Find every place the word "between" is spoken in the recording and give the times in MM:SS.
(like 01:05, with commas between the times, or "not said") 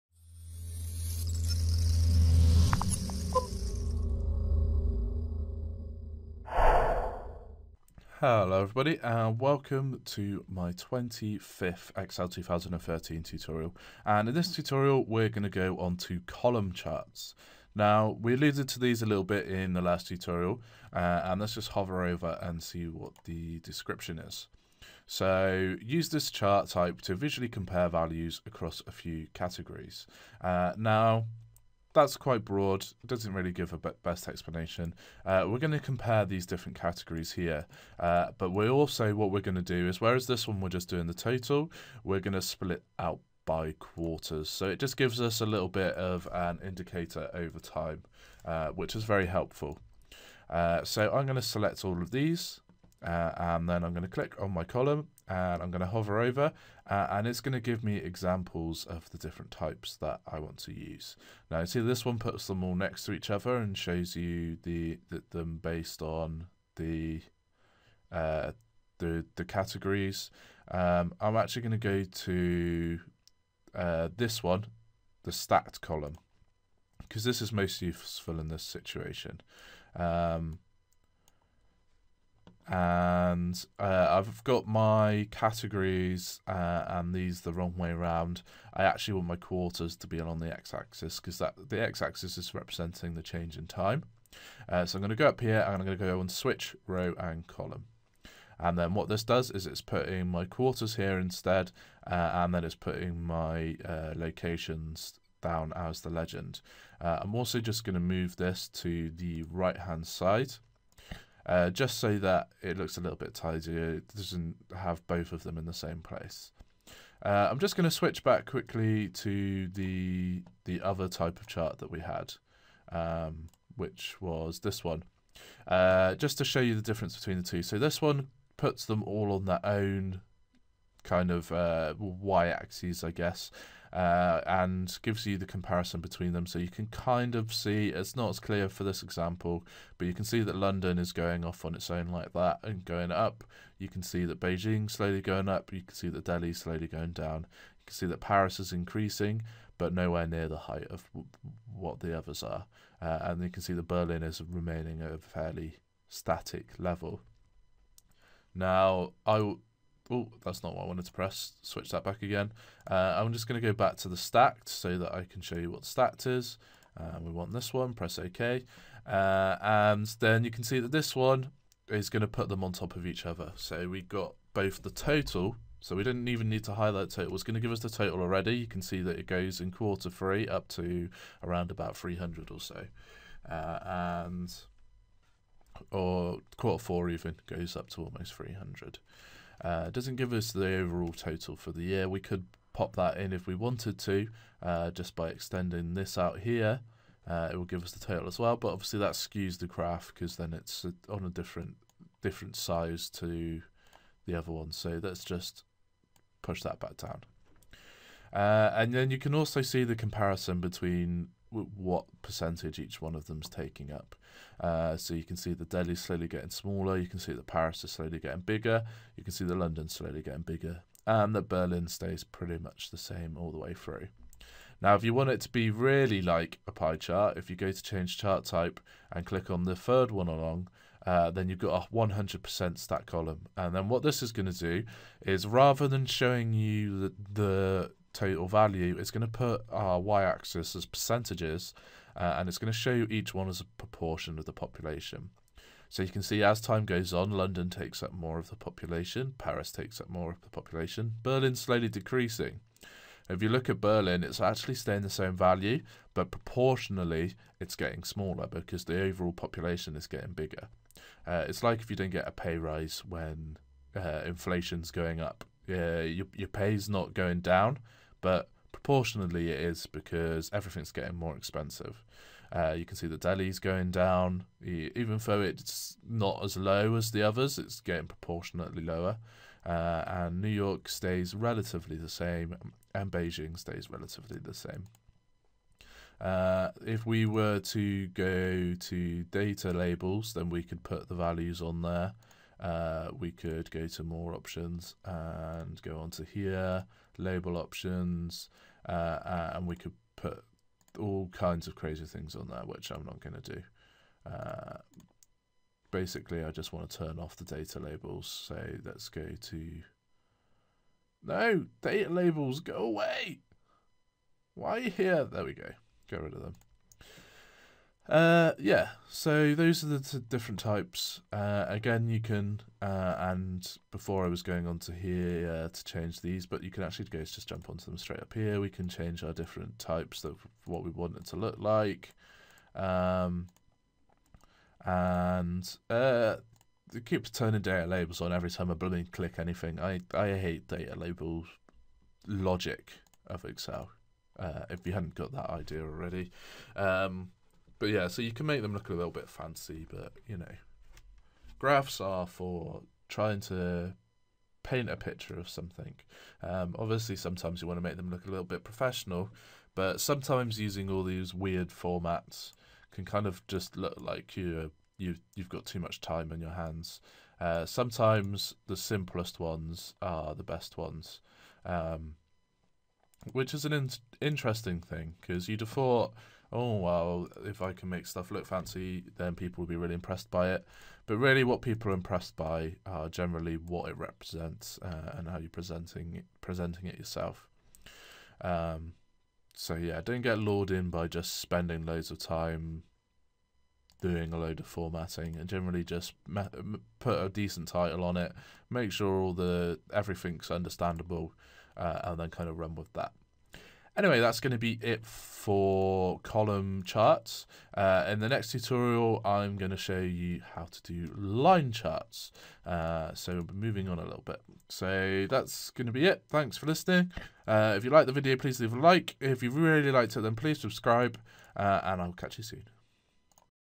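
02:07, 02:15, 03:30.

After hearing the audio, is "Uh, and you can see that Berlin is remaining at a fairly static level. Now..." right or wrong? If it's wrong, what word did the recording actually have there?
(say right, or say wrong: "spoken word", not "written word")
right.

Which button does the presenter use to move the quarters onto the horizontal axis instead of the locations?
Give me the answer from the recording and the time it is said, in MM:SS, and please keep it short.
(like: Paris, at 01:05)
Switch row and column, at 01:36.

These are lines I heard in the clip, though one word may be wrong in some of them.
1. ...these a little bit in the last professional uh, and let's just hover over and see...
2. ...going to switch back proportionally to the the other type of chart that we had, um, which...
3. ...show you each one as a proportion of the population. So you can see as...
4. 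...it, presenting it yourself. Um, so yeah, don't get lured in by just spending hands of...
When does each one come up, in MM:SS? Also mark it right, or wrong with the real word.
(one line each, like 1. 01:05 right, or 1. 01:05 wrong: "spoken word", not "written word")
1. 00:18 wrong: "tutorial", not "professional"
2. 01:57 wrong: "quickly", not "proportionally"
3. 04:02 right
4. 06:26 wrong: "loads", not "hands".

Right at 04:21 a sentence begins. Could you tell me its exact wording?
Uh, it's like if you don't get a pay rise when uh, inflation's going up.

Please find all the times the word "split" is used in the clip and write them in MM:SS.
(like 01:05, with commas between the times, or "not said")
00:42.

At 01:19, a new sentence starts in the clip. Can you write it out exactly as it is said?
Um, and uh, I've got my categories uh, and these the wrong way around.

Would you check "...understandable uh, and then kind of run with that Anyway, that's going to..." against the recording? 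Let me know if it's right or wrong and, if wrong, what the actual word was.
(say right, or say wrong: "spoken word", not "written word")
right.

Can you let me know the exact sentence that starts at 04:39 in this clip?
Uh, and New York stays relatively the same, and Beijing stays relatively the same.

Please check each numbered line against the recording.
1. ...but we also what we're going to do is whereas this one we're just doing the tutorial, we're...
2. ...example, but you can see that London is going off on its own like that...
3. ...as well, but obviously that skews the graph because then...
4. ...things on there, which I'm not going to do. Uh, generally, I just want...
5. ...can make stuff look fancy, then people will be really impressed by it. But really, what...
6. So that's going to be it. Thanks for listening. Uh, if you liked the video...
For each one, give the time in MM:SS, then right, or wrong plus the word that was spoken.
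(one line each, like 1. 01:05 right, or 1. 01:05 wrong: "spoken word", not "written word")
1. 00:38 wrong: "total", not "tutorial"
2. 02:19 right
3. 03:18 right
4. 05:02 wrong: "basically", not "generally"
5. 06:17 right
6. 06:54 right.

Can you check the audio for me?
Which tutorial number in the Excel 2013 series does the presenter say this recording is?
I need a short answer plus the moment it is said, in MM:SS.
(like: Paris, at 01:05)
25th, at 00:10.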